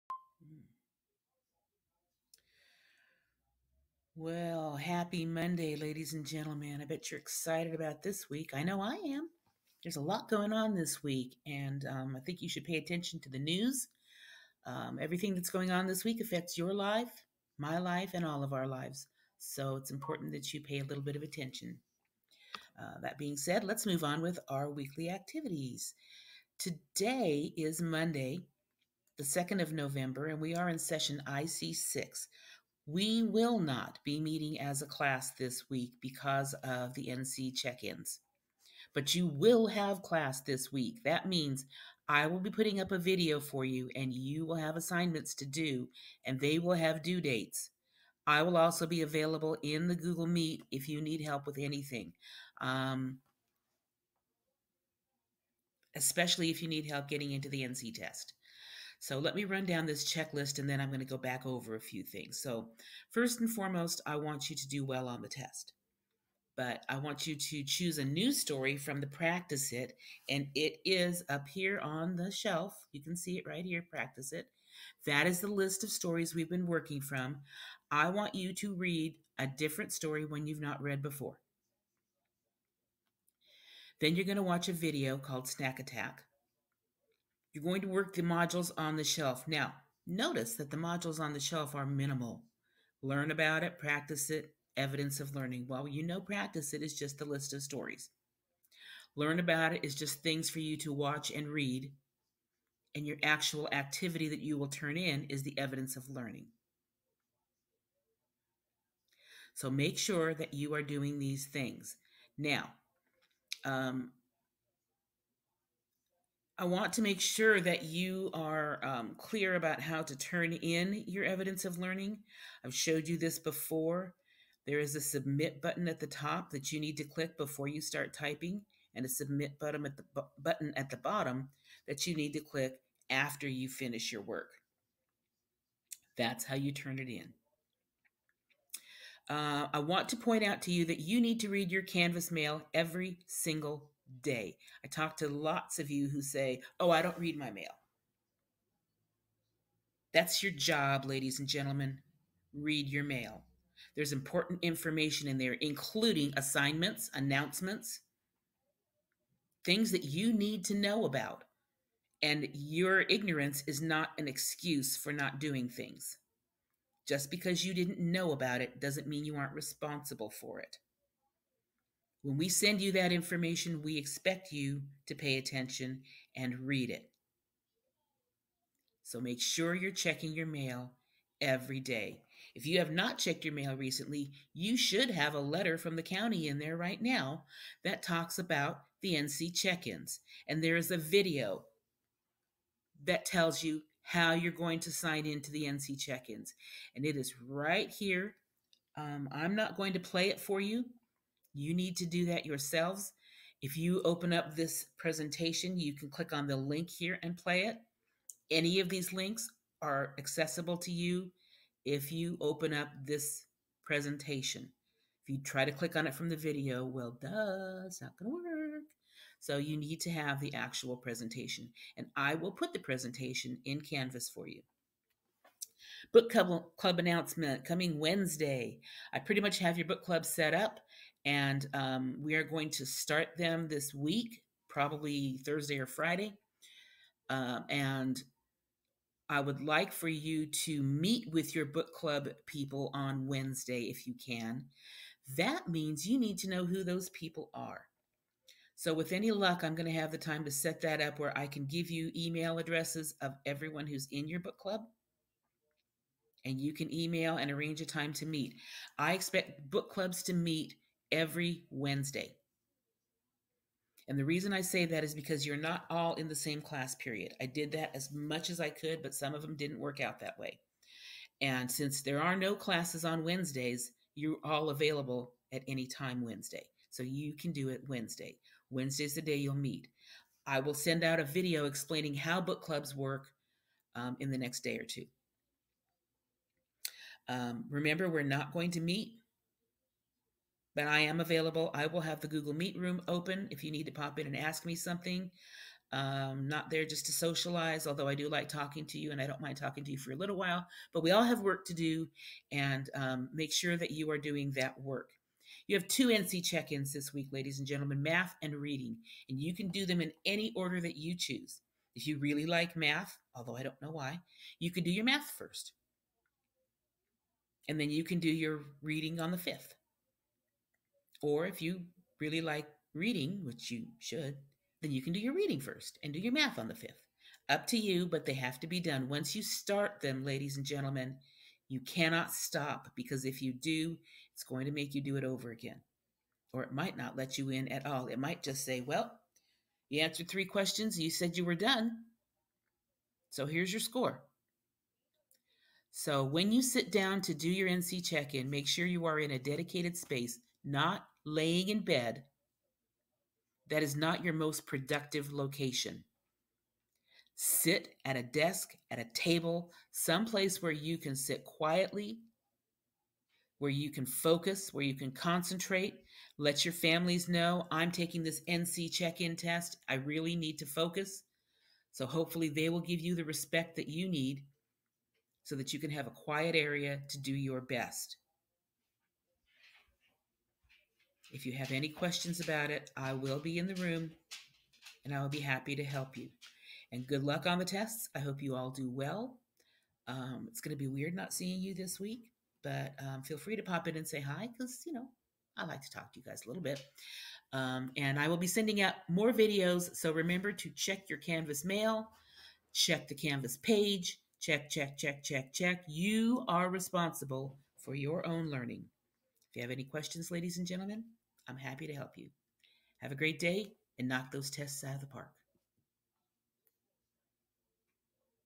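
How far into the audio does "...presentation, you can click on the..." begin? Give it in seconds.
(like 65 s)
204 s.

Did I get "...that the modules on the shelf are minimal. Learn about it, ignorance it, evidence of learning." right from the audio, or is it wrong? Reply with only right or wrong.
wrong.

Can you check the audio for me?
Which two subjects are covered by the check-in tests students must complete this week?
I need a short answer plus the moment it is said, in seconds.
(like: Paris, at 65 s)
math and reading, at 308 s.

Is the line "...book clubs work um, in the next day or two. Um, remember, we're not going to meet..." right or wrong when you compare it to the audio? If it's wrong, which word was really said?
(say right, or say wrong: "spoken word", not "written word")
right.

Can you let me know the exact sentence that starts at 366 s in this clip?
Let your families know I'm taking this NC check in test.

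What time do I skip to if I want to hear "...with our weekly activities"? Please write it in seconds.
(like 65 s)
24 s.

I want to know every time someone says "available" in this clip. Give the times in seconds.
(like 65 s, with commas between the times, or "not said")
49 s, 274 s, 291 s.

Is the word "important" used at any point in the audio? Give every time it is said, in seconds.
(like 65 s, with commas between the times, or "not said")
19 s, 154 s.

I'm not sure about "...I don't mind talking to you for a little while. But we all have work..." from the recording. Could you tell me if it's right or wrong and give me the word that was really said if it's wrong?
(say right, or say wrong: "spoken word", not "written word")
right.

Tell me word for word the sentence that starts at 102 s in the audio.
And your actual activity that you will turn in is the evidence of learning.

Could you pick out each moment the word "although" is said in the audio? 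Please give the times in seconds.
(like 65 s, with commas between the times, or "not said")
297 s, 313 s.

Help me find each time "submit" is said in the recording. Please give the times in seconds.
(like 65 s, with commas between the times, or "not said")
125 s, 129 s.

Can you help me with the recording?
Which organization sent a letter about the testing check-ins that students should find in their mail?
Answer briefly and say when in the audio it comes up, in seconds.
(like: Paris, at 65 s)
the county, at 185 s.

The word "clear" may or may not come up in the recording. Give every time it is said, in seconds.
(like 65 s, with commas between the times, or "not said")
119 s.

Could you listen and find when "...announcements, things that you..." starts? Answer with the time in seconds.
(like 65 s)
157 s.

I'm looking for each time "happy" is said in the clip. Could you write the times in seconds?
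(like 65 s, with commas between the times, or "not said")
4 s, 385 s, 411 s.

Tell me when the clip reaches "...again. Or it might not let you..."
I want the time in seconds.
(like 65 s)
335 s.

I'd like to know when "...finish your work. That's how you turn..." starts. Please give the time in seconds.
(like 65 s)
133 s.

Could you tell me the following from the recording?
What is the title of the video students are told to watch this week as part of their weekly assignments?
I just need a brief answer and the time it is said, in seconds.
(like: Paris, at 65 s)
Snack Attack, at 85 s.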